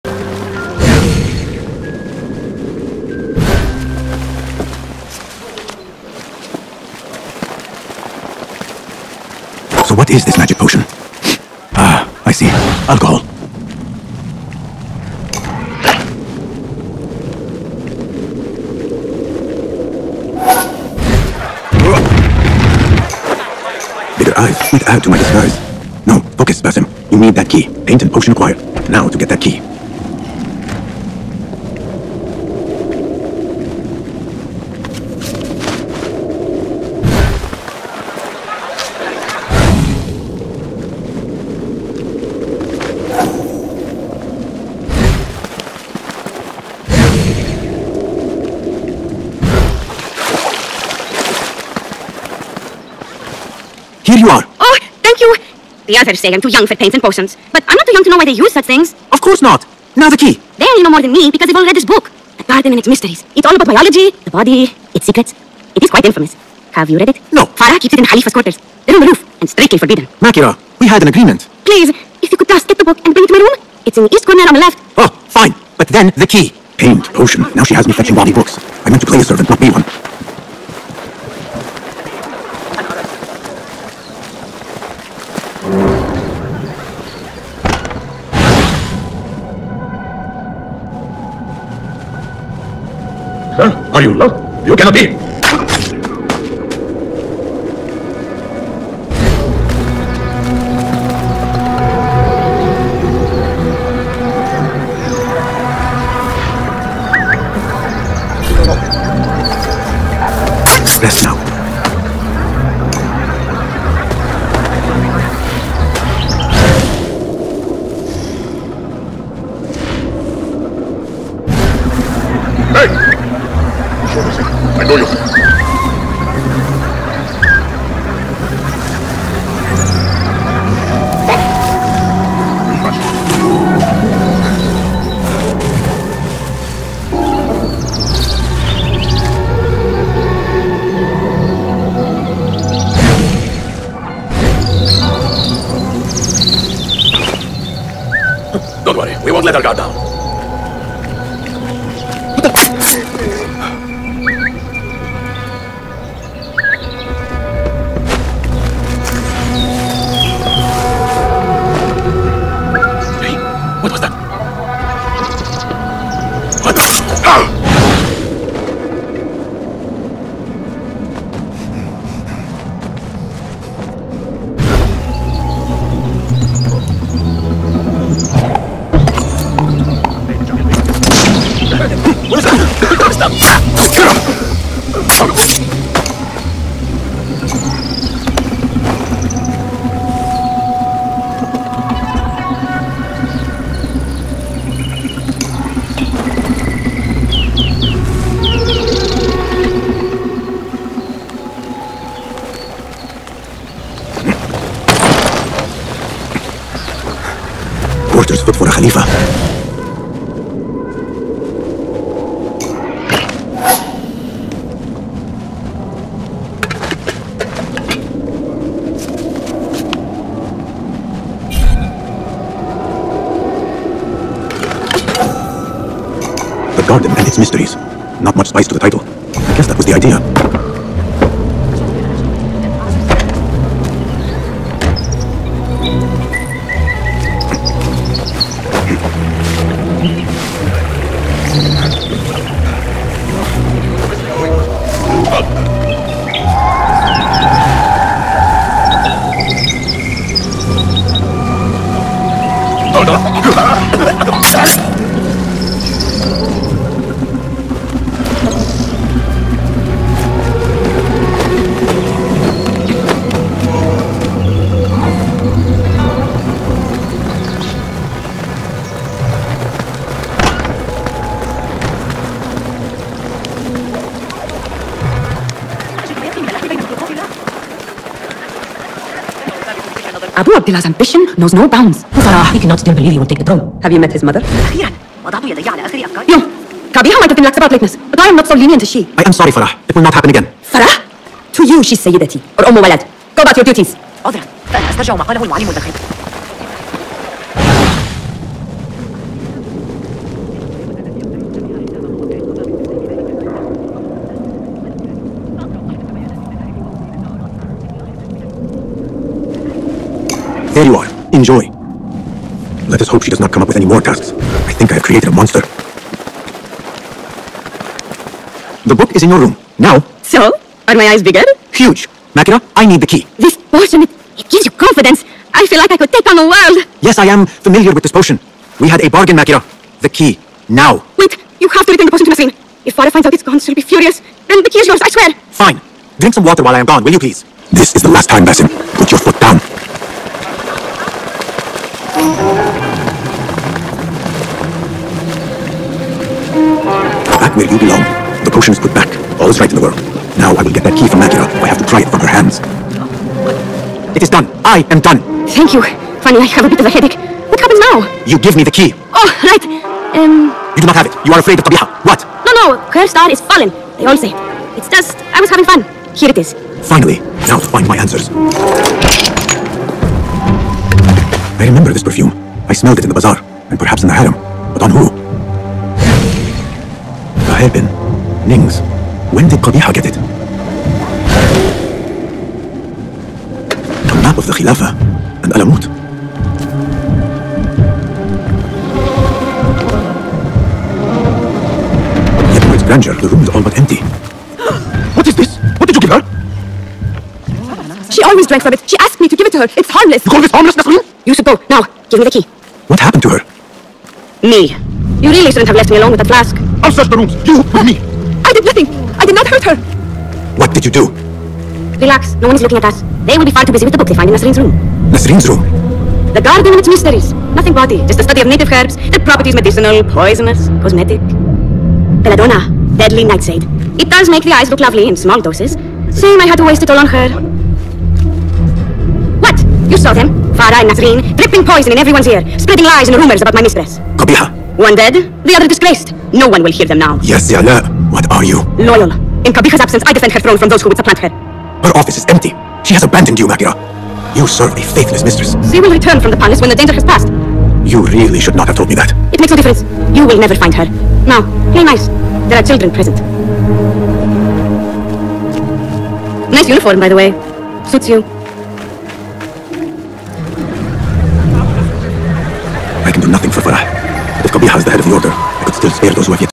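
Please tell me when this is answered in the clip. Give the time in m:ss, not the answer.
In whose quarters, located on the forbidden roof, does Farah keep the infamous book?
1:08.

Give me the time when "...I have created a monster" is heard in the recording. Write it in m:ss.
5:14.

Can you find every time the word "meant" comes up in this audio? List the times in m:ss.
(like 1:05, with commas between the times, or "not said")
1:18.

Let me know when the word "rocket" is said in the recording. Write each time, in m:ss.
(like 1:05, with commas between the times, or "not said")
not said.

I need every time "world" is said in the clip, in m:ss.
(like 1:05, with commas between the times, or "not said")
5:26, 5:49.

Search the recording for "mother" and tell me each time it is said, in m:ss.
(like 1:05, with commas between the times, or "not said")
4:44.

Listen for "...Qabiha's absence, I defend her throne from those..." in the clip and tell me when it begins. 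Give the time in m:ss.
7:19.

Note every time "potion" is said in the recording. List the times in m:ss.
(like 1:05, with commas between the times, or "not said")
0:10, 0:28, 0:57, 1:17, 5:23, 5:28, 5:32, 5:48.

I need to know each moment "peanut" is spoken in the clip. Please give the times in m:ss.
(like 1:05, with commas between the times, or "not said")
not said.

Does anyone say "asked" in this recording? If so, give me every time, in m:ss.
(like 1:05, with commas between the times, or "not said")
6:38.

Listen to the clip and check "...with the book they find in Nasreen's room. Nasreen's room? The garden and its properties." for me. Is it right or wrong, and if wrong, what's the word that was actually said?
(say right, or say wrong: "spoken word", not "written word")
wrong: "mysteries", not "properties".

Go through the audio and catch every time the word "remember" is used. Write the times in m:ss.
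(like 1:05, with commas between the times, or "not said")
6:11.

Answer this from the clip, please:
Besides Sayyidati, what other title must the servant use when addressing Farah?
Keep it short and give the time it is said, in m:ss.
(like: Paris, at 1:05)
Umm Walad, at 4:52.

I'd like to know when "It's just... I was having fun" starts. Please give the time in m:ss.
6:04.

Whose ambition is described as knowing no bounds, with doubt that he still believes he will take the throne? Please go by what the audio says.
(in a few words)
Abu Abdullah.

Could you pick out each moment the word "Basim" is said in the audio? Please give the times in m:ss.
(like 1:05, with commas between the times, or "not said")
0:26, 5:38.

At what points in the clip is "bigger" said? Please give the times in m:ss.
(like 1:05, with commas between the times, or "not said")
0:24, 5:21.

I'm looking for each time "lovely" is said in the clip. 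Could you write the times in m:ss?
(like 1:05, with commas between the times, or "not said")
7:04.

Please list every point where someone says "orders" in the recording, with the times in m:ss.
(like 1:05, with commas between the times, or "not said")
3:28, 7:45.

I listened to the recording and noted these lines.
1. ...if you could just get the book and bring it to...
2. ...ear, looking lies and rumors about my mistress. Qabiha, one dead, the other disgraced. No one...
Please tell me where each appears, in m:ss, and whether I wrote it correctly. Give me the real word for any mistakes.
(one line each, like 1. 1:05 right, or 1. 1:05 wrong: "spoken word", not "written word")
1. 1:11 right
2. 7:12 wrong: "spreading", not "looking".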